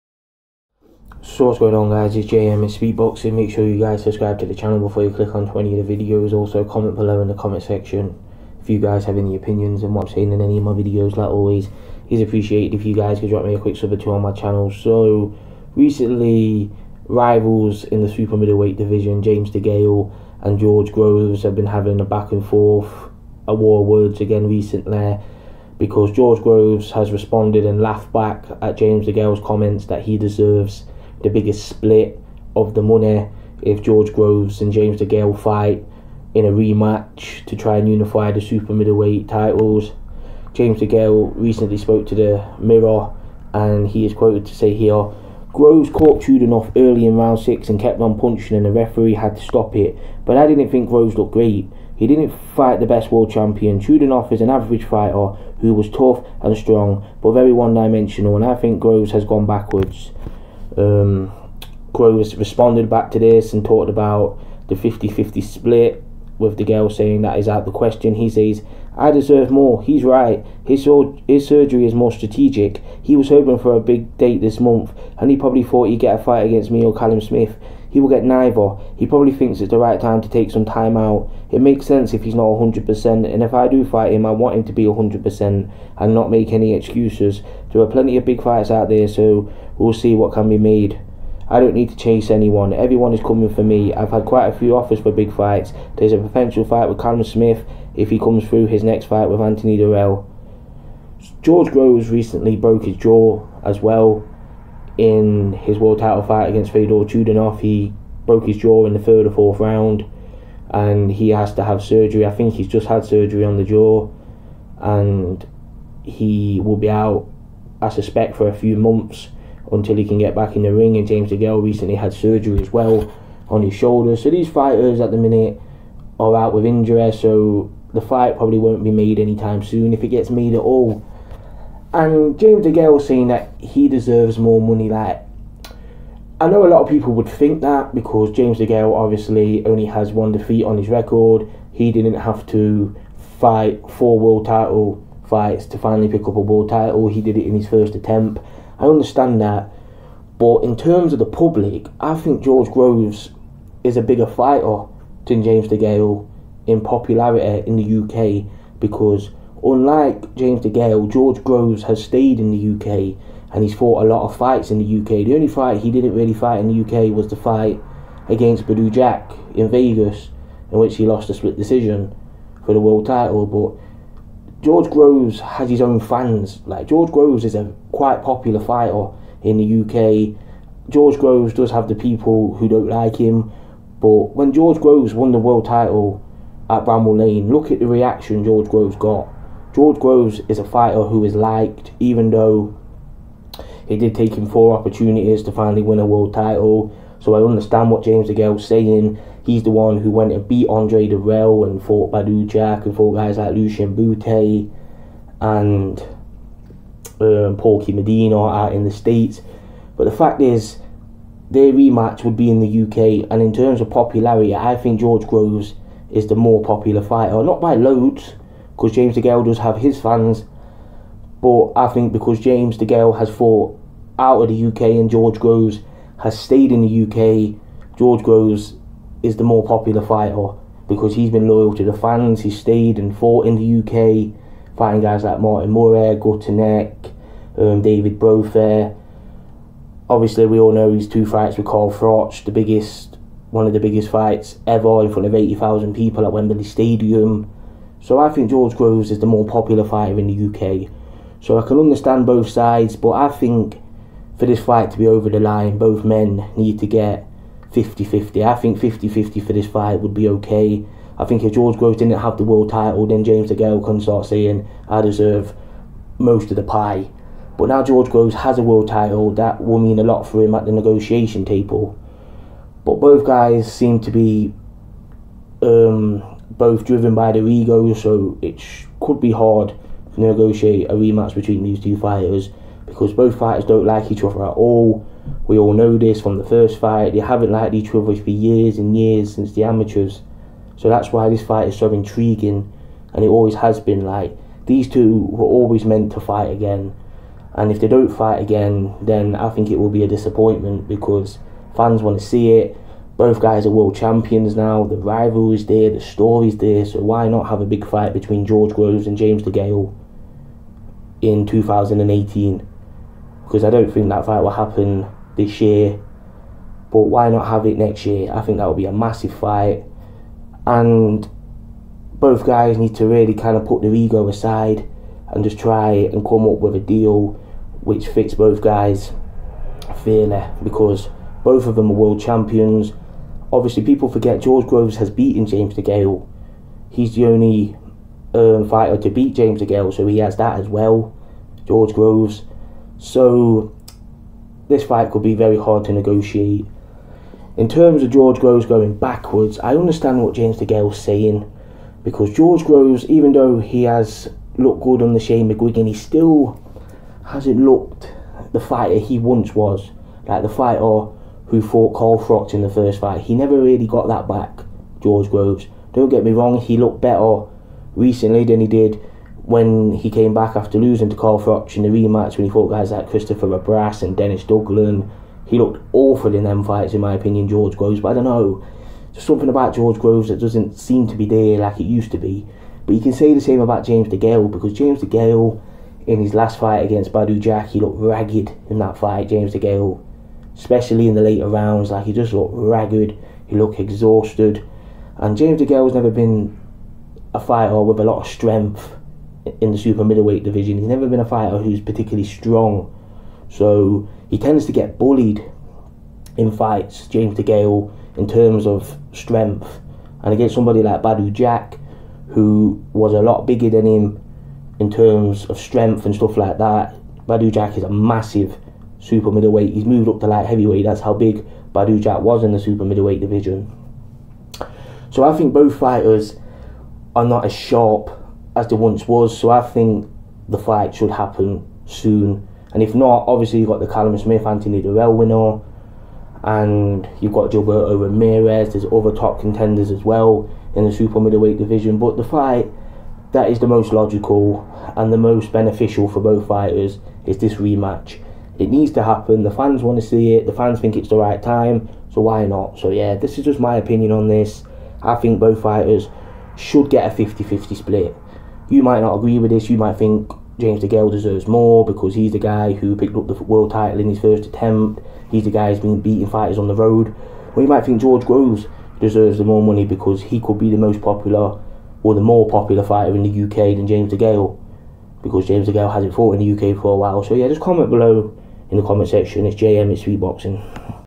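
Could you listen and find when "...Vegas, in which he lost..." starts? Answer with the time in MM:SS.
02:49.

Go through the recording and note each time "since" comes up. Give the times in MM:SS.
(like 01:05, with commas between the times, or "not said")
04:49.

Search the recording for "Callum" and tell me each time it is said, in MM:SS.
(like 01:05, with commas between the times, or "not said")
01:16, 01:36, 07:13.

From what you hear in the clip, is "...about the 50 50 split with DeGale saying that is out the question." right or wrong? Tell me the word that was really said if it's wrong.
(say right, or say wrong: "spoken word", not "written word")
right.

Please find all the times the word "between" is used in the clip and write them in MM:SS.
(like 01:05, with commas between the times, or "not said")
04:41, 05:08.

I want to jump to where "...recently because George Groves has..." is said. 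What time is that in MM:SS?
00:24.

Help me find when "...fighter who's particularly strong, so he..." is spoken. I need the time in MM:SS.
06:41.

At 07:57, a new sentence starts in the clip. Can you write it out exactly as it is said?
So yeah, just comment below in the comment section.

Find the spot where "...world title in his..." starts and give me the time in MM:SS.
07:43.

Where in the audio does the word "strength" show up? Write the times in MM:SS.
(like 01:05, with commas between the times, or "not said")
06:38, 06:49, 06:55.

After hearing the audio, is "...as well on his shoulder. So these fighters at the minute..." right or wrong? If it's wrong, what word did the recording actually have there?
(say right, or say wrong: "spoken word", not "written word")
right.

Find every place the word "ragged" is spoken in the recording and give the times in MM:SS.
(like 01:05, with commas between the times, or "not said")
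06:27, 06:32.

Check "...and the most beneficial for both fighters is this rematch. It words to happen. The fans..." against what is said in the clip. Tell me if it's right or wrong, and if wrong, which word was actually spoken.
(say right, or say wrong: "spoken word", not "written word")
wrong: "needs", not "words".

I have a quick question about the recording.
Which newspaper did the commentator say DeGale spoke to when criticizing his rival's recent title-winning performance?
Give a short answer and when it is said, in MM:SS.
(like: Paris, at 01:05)
The Mirror, at 00:42.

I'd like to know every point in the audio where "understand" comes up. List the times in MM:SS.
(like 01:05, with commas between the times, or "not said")
02:28, 03:17, 04:11, 05:49.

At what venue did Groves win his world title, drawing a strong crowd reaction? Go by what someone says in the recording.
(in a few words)
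Bramall Lane.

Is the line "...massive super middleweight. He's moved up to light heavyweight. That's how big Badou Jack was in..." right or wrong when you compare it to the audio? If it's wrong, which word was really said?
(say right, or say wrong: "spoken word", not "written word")
right.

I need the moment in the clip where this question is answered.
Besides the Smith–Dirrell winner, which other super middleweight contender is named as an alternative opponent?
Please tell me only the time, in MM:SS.
07:17.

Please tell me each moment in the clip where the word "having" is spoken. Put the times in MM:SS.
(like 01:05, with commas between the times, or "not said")
00:21.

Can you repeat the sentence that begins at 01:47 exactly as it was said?
He broke his jaw in the third or fourth round and he has to have surgery.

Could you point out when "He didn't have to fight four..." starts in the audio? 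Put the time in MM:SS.
02:21.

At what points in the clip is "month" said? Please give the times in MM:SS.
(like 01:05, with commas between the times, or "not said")
01:14, 01:58.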